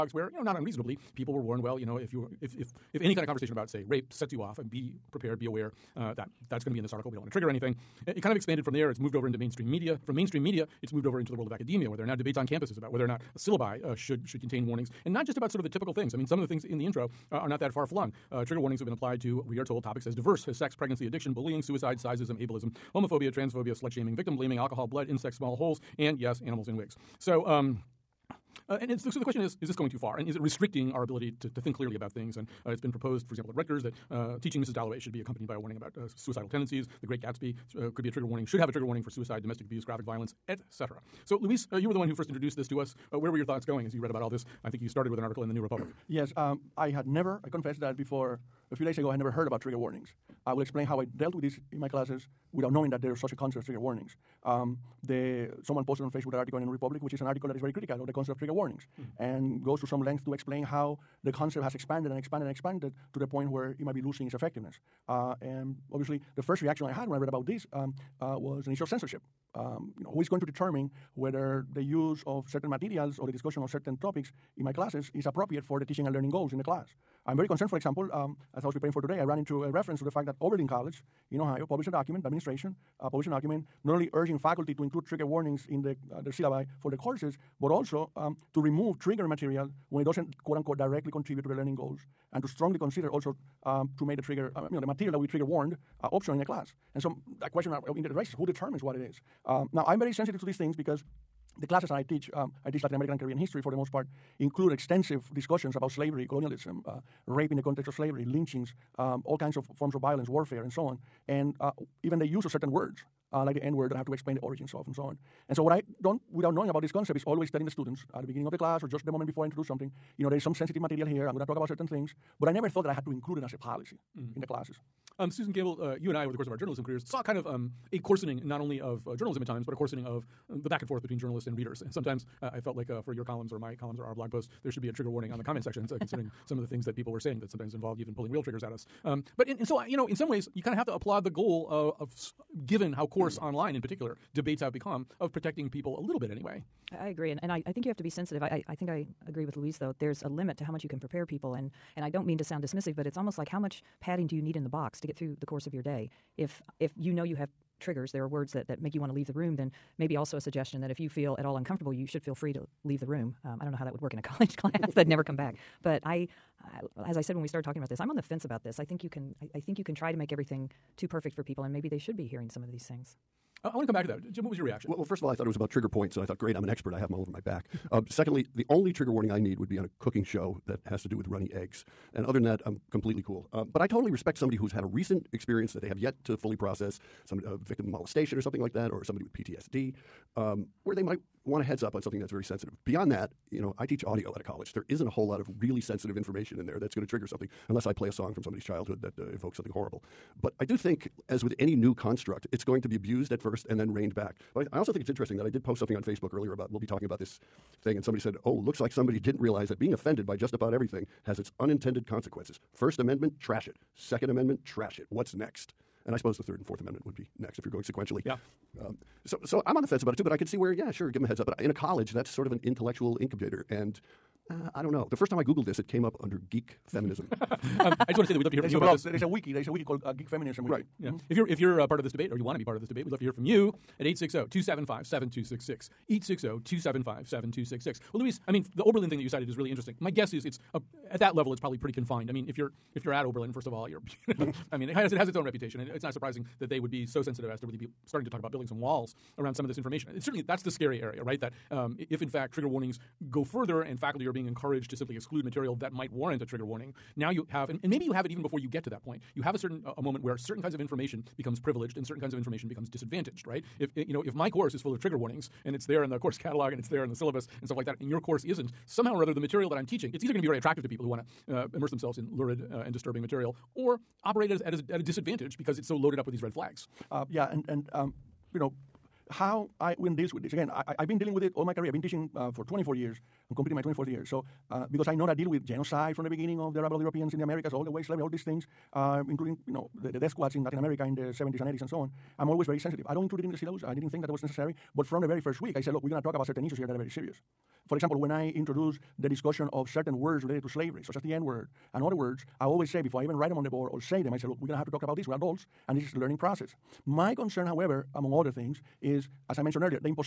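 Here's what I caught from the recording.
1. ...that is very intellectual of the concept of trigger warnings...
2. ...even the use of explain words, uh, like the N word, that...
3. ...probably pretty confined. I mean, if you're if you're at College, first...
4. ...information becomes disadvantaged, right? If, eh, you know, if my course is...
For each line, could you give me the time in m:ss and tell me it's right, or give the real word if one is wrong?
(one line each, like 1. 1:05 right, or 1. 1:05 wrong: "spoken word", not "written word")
1. 0:57 wrong: "critical", not "intellectual"
2. 1:52 wrong: "certain", not "explain"
3. 4:01 wrong: "Oberlin", not "College"
4. 4:22 right.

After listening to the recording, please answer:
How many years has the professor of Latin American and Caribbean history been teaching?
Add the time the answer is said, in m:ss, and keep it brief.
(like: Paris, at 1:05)
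24, at 4:42.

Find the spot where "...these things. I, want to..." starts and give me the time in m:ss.
2:52.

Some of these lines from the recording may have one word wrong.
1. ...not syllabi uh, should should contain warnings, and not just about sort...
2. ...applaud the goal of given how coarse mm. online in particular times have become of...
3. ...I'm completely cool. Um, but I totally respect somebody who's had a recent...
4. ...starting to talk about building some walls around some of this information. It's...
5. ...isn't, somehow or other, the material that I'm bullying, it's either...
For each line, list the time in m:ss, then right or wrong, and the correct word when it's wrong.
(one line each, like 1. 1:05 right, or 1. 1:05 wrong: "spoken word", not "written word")
1. 0:13 right
2. 2:20 wrong: "debates", not "times"
3. 3:02 right
4. 4:08 right
5. 4:28 wrong: "teaching", not "bullying".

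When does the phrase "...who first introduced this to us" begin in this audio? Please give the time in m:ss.
0:42.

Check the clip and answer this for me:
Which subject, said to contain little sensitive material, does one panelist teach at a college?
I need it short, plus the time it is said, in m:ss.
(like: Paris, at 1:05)
Audio, at 3:14.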